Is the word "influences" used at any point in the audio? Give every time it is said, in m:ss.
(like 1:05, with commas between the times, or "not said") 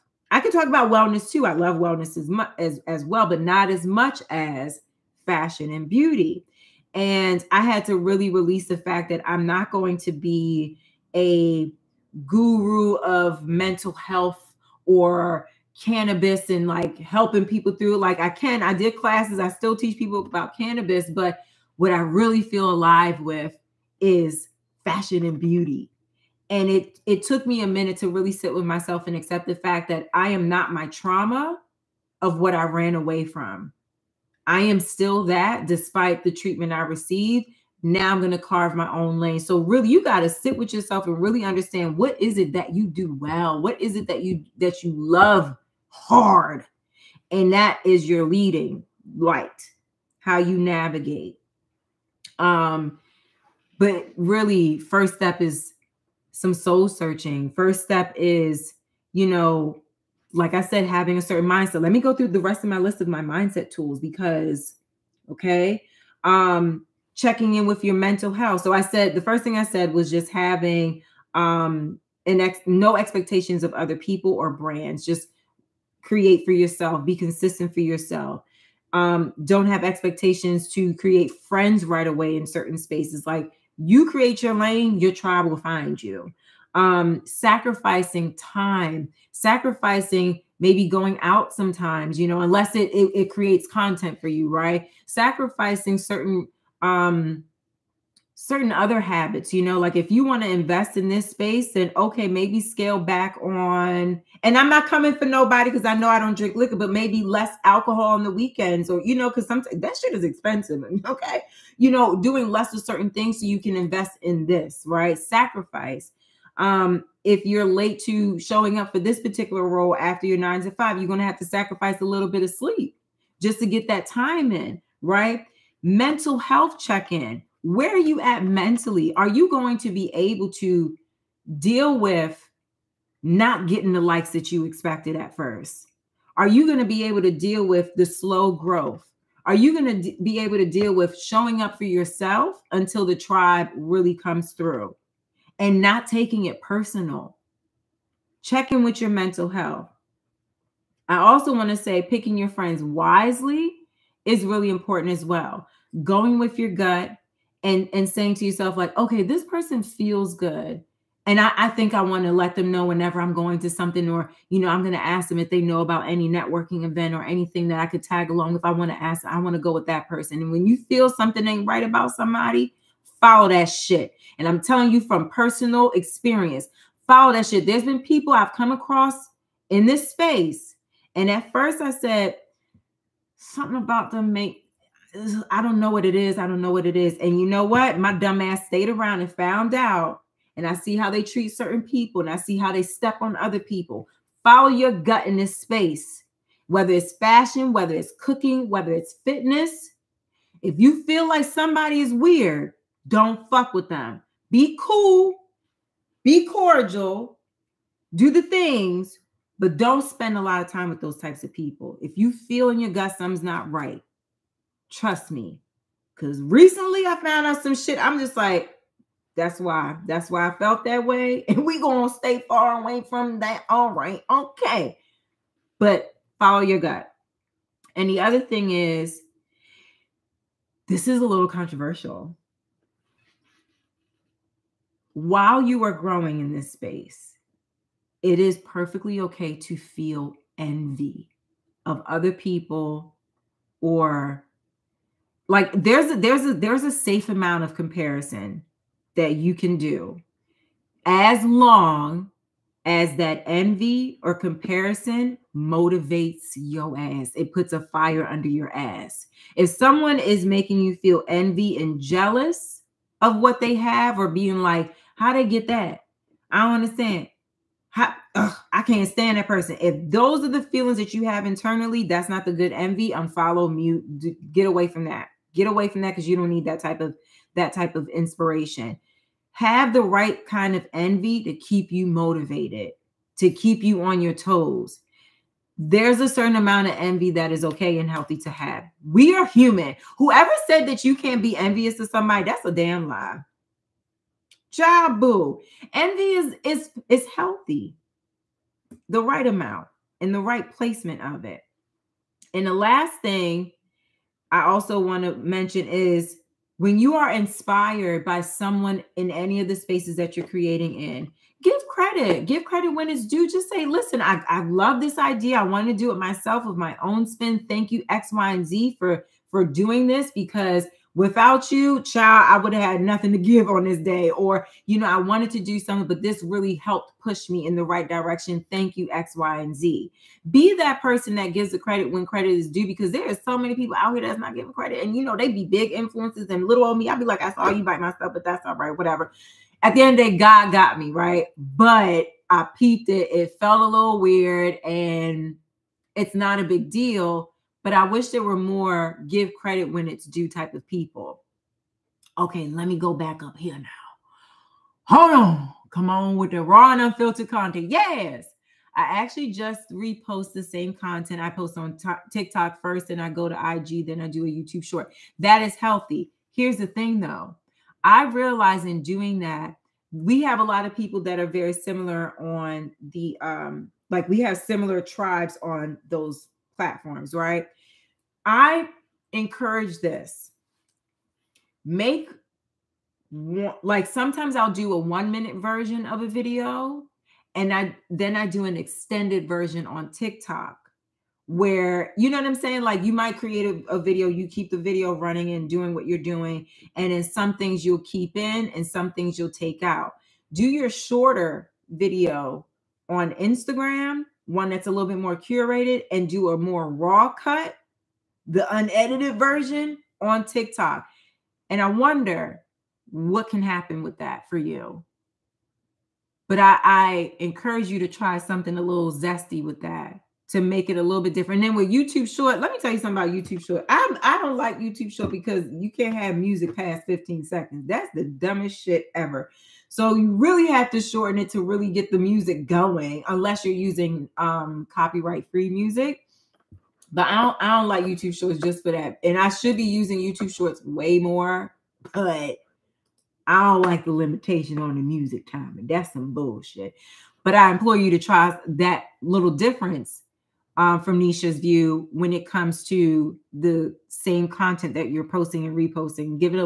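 5:35.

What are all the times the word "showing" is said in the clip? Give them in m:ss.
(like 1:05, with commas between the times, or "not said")
1:58, 2:21.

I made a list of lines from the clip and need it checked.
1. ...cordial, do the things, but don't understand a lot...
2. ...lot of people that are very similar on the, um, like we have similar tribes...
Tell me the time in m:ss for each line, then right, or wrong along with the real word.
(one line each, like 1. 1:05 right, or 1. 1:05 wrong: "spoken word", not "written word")
1. 3:26 wrong: "spend", not "understand"
2. 6:10 right.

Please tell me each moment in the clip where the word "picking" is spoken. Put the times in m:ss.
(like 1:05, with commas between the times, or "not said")
2:32.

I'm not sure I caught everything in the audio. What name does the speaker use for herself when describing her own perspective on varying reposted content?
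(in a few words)
Nisha.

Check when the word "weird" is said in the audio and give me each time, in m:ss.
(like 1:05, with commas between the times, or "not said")
3:22, 5:44.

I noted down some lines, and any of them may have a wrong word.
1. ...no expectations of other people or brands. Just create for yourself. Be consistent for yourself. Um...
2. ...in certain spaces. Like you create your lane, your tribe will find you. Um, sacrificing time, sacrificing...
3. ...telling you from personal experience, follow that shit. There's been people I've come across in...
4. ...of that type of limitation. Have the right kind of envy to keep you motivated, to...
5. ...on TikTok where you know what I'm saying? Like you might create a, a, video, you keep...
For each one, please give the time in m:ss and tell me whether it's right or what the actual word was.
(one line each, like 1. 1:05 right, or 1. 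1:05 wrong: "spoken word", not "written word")
1. 1:12 right
2. 1:22 right
3. 2:54 right
4. 4:37 wrong: "inspiration", not "limitation"
5. 6:29 right.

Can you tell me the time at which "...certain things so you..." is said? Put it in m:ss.
1:52.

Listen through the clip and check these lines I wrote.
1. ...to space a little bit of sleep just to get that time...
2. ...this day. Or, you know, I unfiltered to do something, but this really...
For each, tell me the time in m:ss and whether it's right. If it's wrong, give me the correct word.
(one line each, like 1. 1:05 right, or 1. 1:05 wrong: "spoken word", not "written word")
1. 2:01 wrong: "sacrifice", not "space"
2. 5:23 wrong: "wanted", not "unfiltered".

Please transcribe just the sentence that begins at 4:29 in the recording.
If those are the feelings that you have internally, that's not the good envy.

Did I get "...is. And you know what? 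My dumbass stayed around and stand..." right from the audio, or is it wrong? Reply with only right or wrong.
wrong.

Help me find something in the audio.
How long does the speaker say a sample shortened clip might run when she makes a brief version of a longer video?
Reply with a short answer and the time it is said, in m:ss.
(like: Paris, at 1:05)
1 minute, at 6:24.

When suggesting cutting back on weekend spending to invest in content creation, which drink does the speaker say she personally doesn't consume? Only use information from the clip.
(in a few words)
liquor.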